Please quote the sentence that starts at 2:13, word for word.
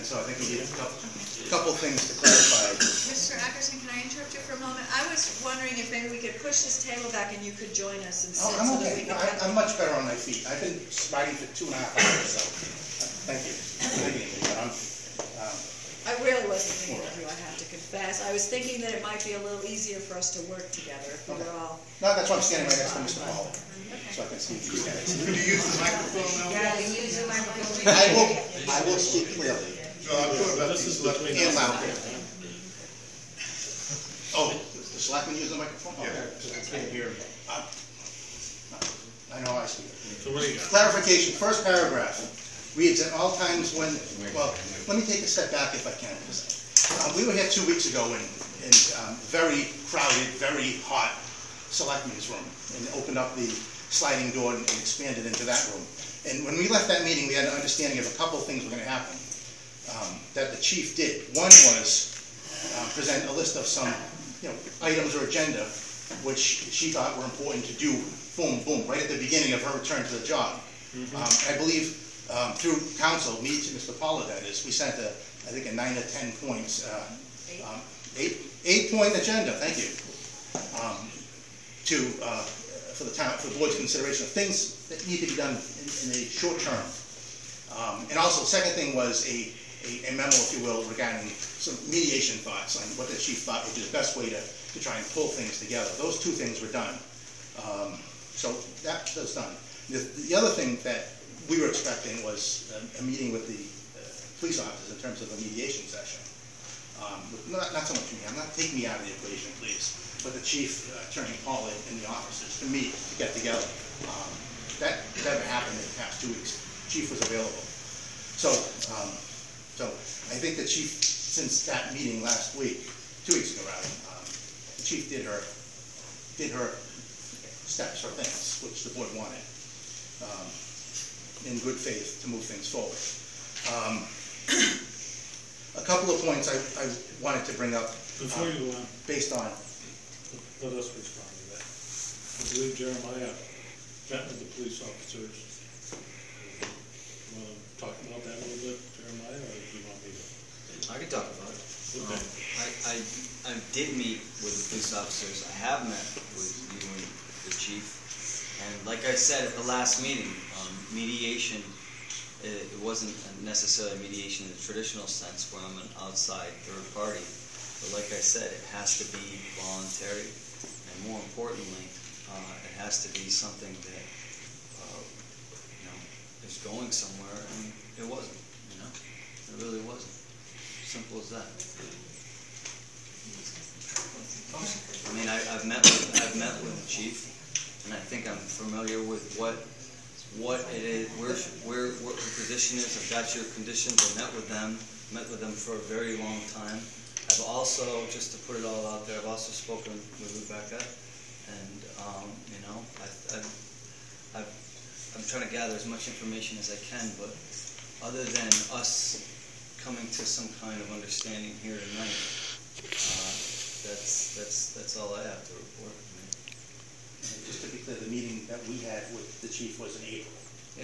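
Um, a couple of points I, I wanted to bring up.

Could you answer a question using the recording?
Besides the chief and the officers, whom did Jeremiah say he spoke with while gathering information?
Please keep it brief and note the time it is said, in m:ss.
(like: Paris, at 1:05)
Rebecca, at 3:20.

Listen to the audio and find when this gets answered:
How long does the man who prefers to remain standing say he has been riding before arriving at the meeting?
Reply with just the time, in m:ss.
0:11.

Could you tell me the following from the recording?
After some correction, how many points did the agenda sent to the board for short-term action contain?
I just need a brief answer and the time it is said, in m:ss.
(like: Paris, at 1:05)
8, at 1:18.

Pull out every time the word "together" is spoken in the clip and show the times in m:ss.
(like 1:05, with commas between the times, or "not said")
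0:20, 1:35, 1:53.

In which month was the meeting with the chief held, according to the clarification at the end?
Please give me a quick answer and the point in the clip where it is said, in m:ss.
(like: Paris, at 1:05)
April, at 3:40.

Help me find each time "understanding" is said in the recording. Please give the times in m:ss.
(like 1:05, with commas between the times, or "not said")
0:57, 3:30.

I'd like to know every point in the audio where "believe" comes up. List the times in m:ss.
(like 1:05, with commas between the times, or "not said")
1:11, 2:22.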